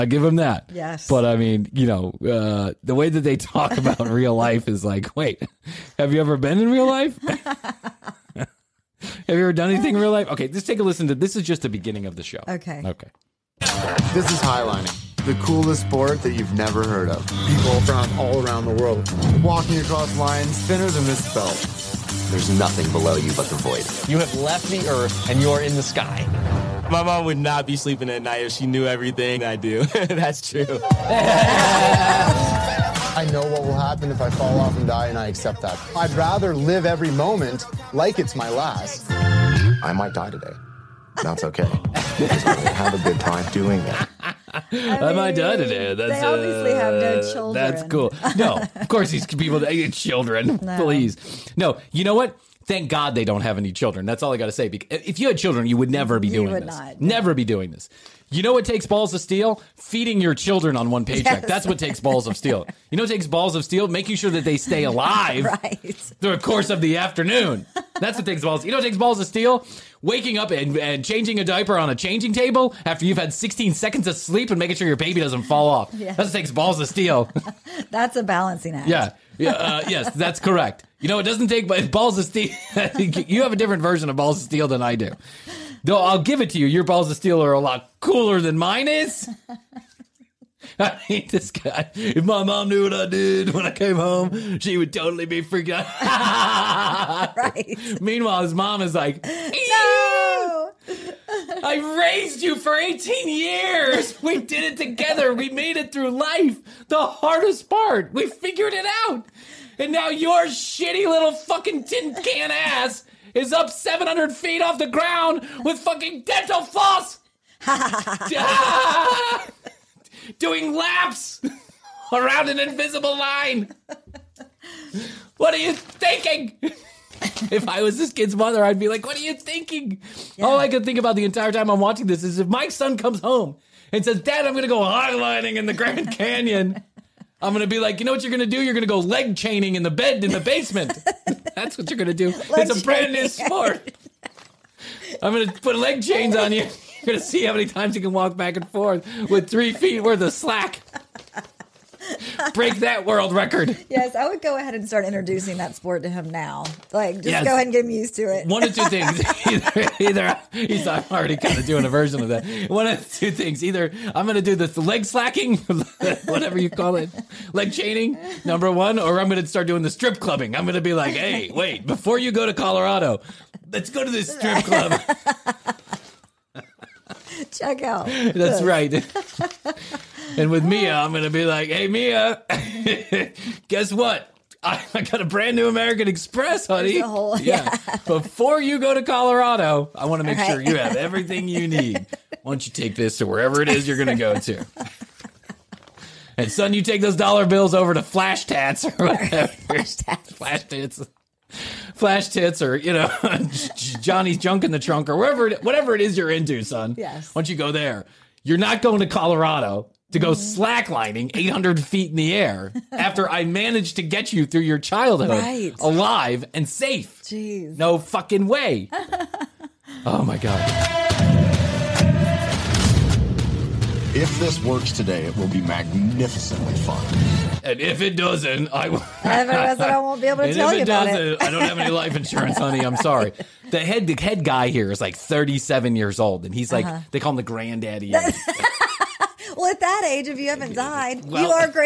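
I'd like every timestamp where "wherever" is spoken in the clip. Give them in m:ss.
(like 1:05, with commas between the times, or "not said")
3:13.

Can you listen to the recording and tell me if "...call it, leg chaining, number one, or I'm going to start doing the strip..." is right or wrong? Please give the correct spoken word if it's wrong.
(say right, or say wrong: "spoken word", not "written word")
right.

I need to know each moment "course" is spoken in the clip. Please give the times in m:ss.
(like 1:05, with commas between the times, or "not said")
0:48, 1:06.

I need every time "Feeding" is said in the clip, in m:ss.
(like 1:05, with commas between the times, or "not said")
0:59.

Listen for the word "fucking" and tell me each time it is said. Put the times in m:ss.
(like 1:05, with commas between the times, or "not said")
1:51, 1:55, 3:37.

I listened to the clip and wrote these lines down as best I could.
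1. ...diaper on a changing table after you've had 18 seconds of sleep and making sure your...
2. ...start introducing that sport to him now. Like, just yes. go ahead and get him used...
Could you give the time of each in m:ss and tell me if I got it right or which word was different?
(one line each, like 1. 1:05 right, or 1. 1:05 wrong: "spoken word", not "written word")
1. 1:11 wrong: "16", not "18"
2. 2:34 right.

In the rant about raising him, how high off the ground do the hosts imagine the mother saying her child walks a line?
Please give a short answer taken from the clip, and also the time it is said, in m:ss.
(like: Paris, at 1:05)
700 feet, at 1:53.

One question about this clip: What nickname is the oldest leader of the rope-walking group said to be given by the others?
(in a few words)
The granddaddy.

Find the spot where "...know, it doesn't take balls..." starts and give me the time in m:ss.
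1:21.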